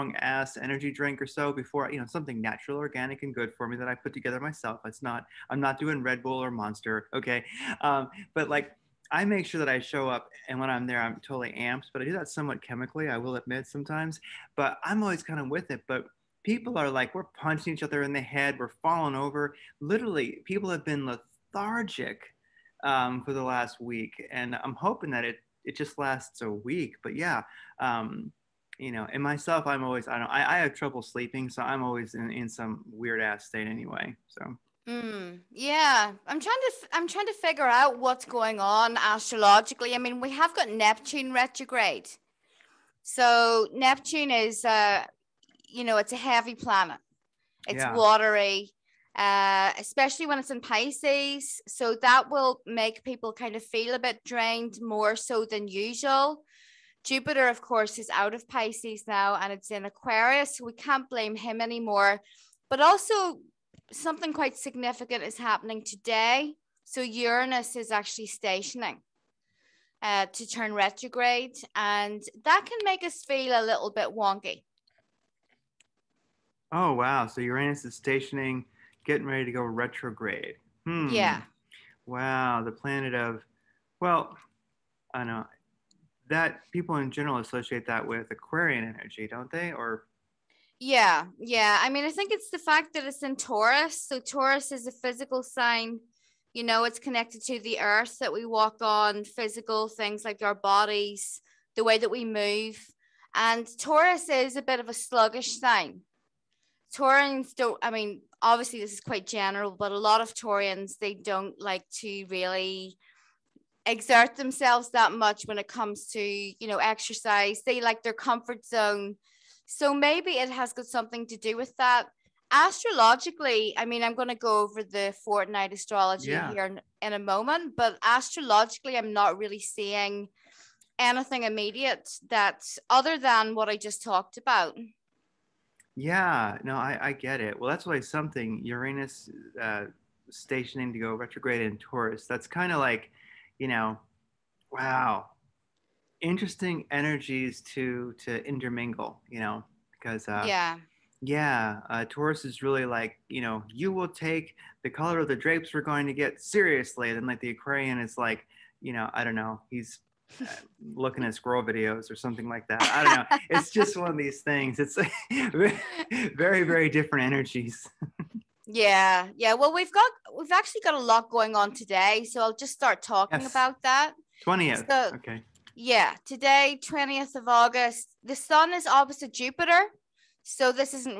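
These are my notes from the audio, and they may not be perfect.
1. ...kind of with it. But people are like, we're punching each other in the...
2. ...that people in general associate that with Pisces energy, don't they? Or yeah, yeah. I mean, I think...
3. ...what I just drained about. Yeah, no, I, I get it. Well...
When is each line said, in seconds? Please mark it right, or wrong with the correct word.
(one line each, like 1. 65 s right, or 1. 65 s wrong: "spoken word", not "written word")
1. 15 s right
2. 86 s wrong: "Aquarian", not "Pisces"
3. 133 s wrong: "talked", not "drained".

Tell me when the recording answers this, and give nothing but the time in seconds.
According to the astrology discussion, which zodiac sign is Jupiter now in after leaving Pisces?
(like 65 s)
59 s.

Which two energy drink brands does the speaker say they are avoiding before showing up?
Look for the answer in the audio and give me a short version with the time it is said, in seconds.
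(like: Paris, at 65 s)
Red Bull or Monster, at 6 s.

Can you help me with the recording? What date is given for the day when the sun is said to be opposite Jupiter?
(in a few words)
20 August.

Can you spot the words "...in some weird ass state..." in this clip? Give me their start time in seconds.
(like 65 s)
32 s.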